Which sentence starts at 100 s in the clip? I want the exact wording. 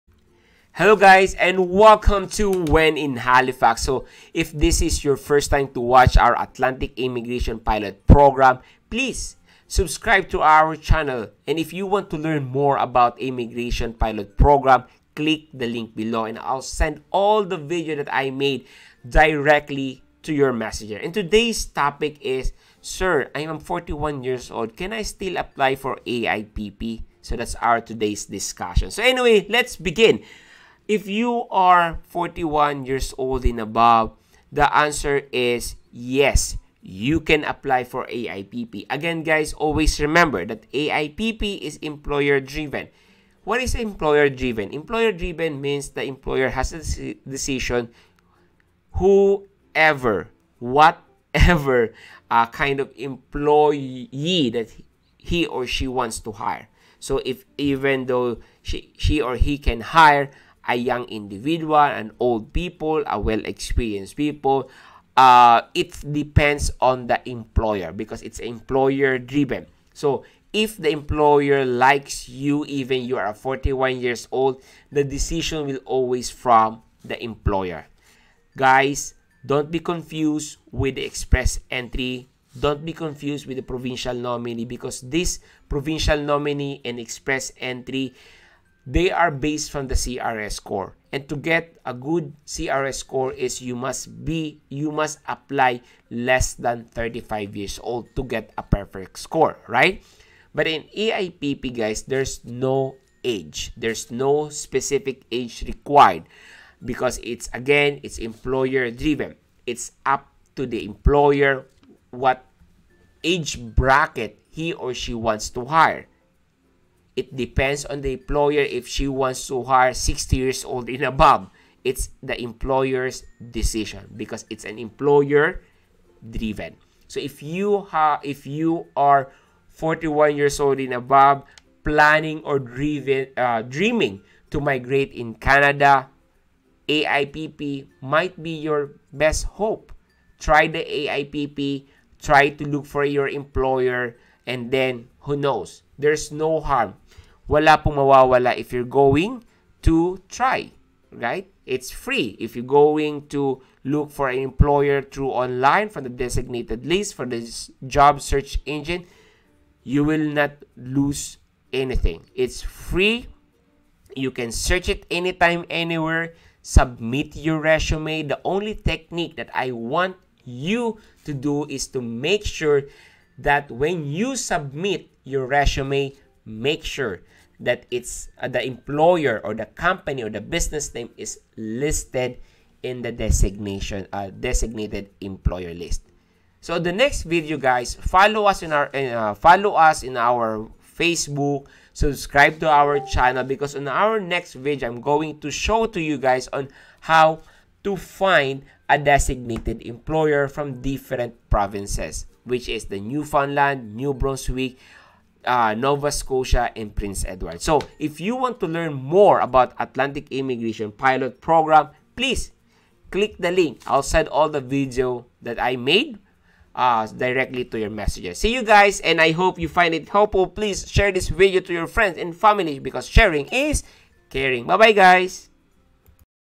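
But in AIPP, guys, there's no age.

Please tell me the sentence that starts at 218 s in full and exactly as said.
See you guys, and I hope you find it helpful.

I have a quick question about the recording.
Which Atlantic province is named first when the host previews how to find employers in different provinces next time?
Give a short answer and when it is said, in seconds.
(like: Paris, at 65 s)
Newfoundland, at 203 s.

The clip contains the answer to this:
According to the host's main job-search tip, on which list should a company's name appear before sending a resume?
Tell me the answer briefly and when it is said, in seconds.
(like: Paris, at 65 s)
Designated employer list, at 184 s.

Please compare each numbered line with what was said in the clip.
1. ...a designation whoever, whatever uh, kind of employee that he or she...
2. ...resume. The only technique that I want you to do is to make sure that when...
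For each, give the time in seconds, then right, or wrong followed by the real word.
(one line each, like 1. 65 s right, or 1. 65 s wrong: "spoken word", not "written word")
1. 46 s wrong: "decision", not "designation"
2. 167 s right.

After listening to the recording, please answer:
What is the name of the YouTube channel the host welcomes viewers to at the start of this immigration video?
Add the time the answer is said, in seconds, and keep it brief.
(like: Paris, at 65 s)
When in Halifax, at 2 s.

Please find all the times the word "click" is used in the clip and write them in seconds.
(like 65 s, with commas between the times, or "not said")
15 s, 213 s.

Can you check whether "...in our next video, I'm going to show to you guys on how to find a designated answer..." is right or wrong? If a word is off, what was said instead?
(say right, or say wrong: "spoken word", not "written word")
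wrong: "employer", not "answer".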